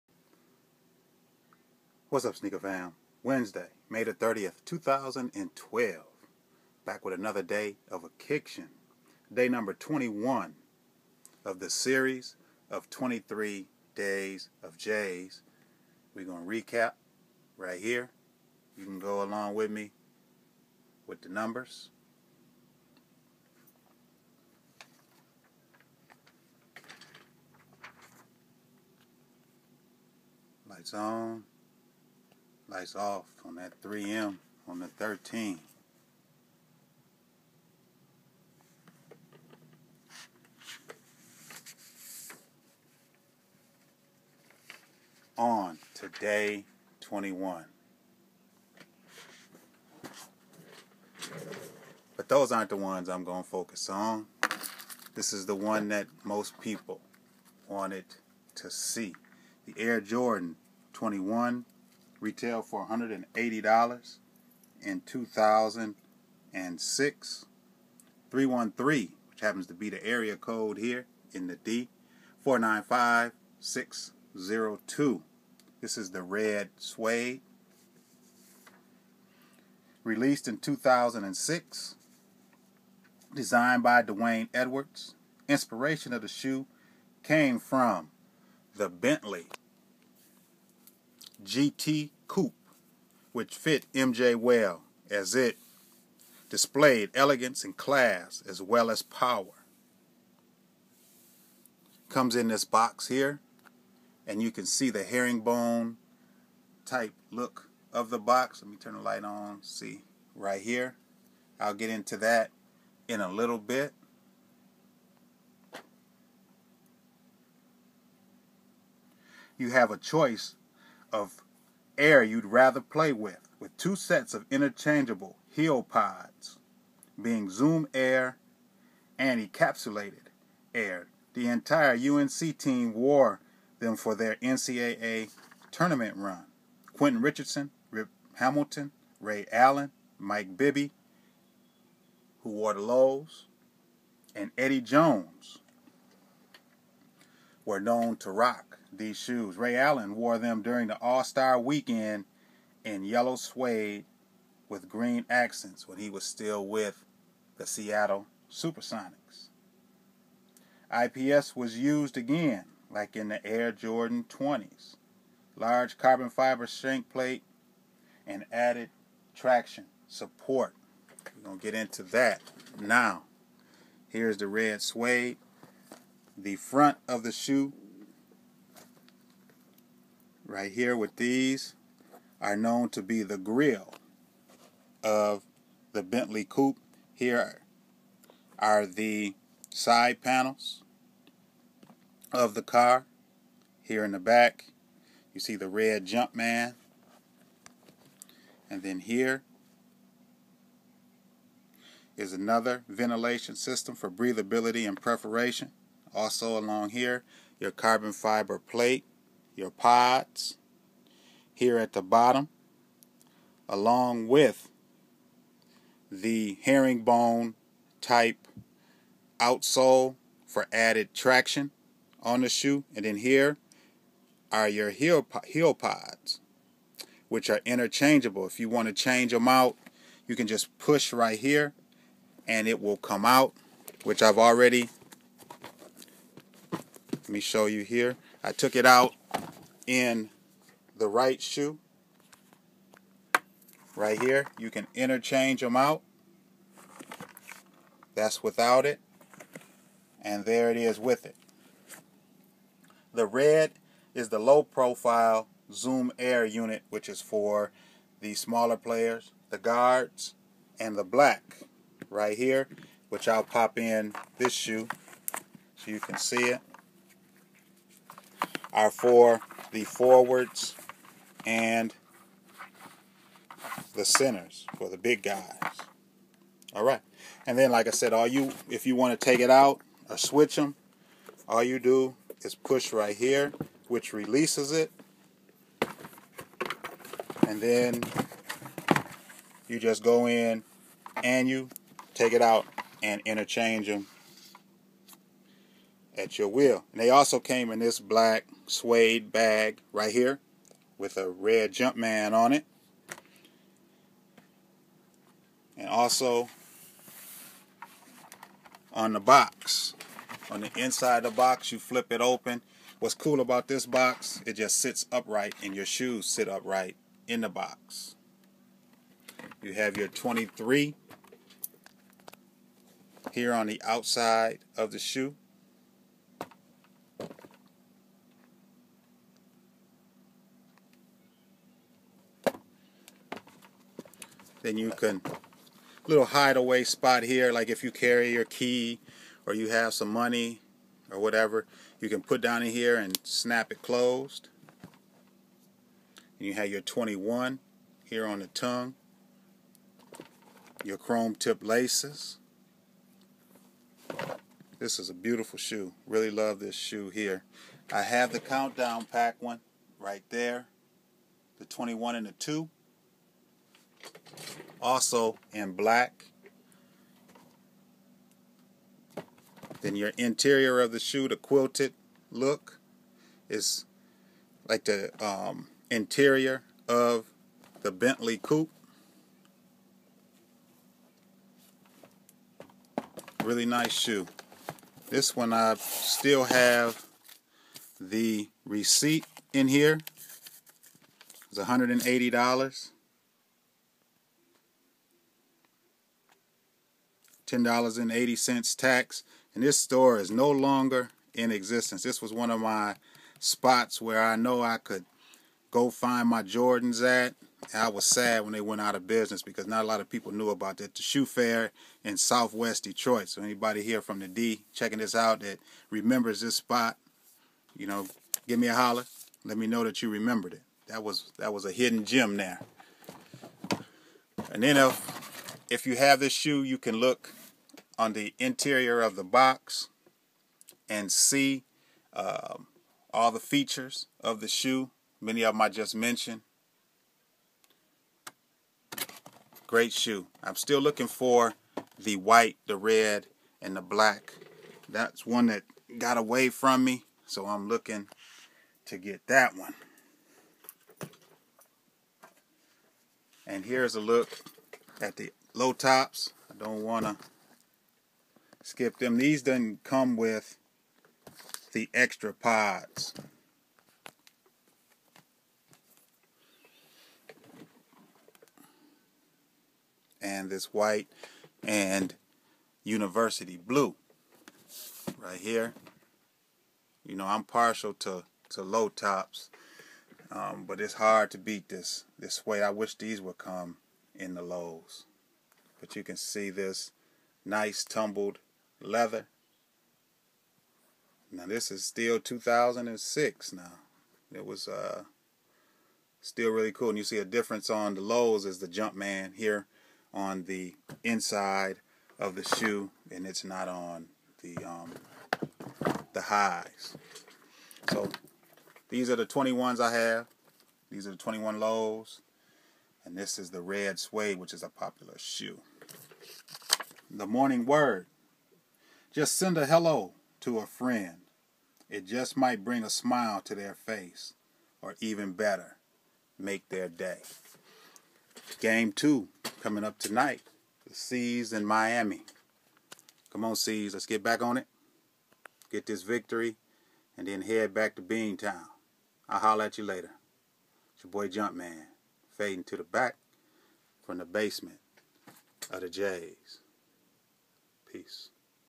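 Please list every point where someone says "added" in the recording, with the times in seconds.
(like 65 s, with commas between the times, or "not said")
168 s, 220 s.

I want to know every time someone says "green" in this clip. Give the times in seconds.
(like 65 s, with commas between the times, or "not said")
154 s.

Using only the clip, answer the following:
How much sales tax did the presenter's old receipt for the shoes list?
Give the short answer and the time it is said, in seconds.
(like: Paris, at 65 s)
$10.80, at 397 s.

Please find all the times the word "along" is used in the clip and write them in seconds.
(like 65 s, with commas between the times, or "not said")
19 s, 206 s, 213 s.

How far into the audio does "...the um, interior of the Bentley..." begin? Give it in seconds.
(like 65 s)
374 s.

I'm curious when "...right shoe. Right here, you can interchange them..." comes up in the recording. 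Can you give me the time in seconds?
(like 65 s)
241 s.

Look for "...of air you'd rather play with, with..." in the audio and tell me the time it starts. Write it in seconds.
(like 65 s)
121 s.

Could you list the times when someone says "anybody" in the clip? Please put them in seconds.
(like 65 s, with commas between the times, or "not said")
413 s.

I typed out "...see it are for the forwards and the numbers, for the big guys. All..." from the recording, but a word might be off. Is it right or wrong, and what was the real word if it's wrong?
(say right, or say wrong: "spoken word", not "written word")
wrong: "centers", not "numbers".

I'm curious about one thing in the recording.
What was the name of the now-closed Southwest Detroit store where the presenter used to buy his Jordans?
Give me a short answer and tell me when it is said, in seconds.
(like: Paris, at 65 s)
The Shoe Fair, at 410 s.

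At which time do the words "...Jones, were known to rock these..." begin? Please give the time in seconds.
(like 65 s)
144 s.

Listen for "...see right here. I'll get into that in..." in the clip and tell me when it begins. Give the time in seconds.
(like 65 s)
109 s.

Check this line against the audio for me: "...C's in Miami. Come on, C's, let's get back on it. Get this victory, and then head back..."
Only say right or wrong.
right.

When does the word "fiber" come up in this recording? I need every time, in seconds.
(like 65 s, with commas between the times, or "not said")
166 s, 208 s.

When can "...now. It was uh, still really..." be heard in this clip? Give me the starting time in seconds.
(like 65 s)
493 s.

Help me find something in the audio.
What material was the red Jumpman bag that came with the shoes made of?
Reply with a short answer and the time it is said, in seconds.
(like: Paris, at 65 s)
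black suede, at 297 s.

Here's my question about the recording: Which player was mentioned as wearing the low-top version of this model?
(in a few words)
Mike Bibby.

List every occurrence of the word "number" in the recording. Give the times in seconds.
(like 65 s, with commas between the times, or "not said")
9 s, 21 s.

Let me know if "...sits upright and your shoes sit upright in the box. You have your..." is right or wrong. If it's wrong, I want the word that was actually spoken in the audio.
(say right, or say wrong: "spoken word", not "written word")
right.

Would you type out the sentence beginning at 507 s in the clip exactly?
So these are the 21s I have.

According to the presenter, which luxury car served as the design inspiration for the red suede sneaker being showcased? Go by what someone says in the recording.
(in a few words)
Bentley GT Coupe.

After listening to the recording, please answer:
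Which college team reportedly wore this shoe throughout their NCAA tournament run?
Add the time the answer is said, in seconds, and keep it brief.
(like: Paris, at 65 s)
UNC, at 131 s.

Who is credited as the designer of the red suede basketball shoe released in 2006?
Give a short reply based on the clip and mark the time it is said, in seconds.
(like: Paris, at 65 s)
D'Wayne Edwards, at 84 s.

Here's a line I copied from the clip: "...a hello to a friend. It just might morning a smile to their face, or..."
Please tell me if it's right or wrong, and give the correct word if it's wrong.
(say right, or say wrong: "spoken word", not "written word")
wrong: "bring", not "morning".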